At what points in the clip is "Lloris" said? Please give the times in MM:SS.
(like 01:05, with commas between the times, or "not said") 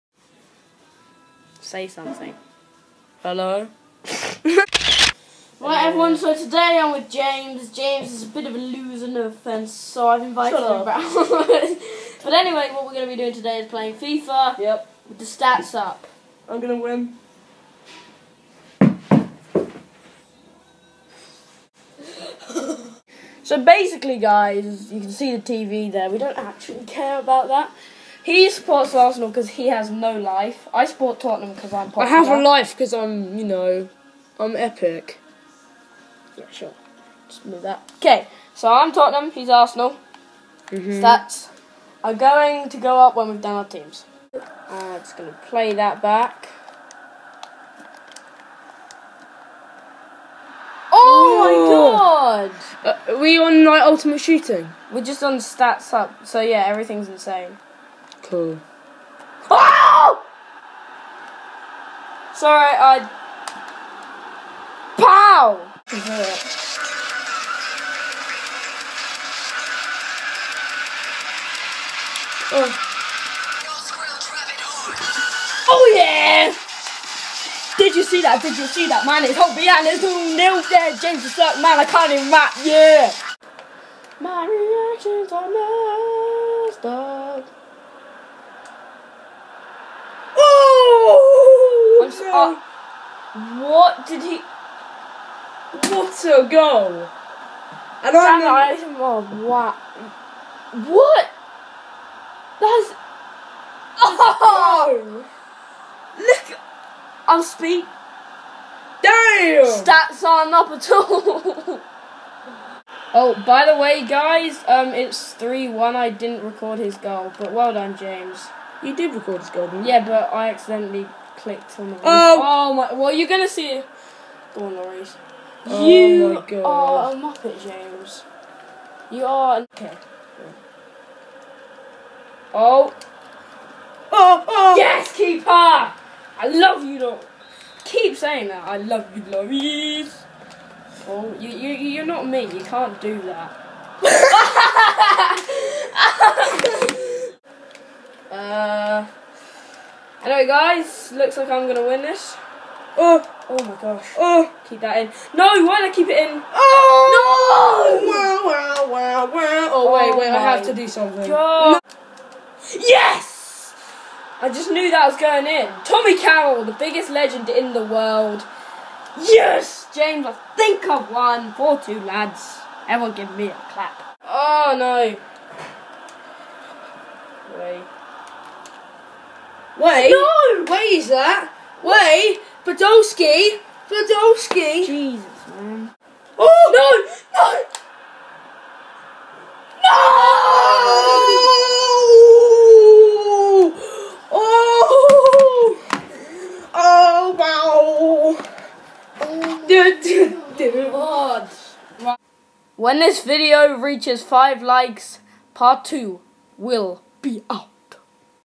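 02:04, 02:19.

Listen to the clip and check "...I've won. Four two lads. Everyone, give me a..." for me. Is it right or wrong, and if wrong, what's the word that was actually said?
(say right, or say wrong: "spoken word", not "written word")
right.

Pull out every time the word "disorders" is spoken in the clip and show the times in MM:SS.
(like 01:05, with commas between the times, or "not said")
not said.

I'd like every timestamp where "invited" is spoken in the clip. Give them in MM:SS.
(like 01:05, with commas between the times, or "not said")
00:10.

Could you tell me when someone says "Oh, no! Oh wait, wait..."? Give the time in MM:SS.
02:36.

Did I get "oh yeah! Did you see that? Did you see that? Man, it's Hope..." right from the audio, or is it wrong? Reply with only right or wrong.
right.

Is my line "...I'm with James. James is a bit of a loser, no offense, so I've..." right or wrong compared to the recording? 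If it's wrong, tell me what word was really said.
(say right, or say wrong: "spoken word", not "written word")
right.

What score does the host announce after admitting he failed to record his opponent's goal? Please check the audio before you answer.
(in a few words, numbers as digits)
3-1.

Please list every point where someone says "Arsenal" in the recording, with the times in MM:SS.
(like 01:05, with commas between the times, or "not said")
00:28, 00:39.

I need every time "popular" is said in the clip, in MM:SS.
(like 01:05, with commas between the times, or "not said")
00:31.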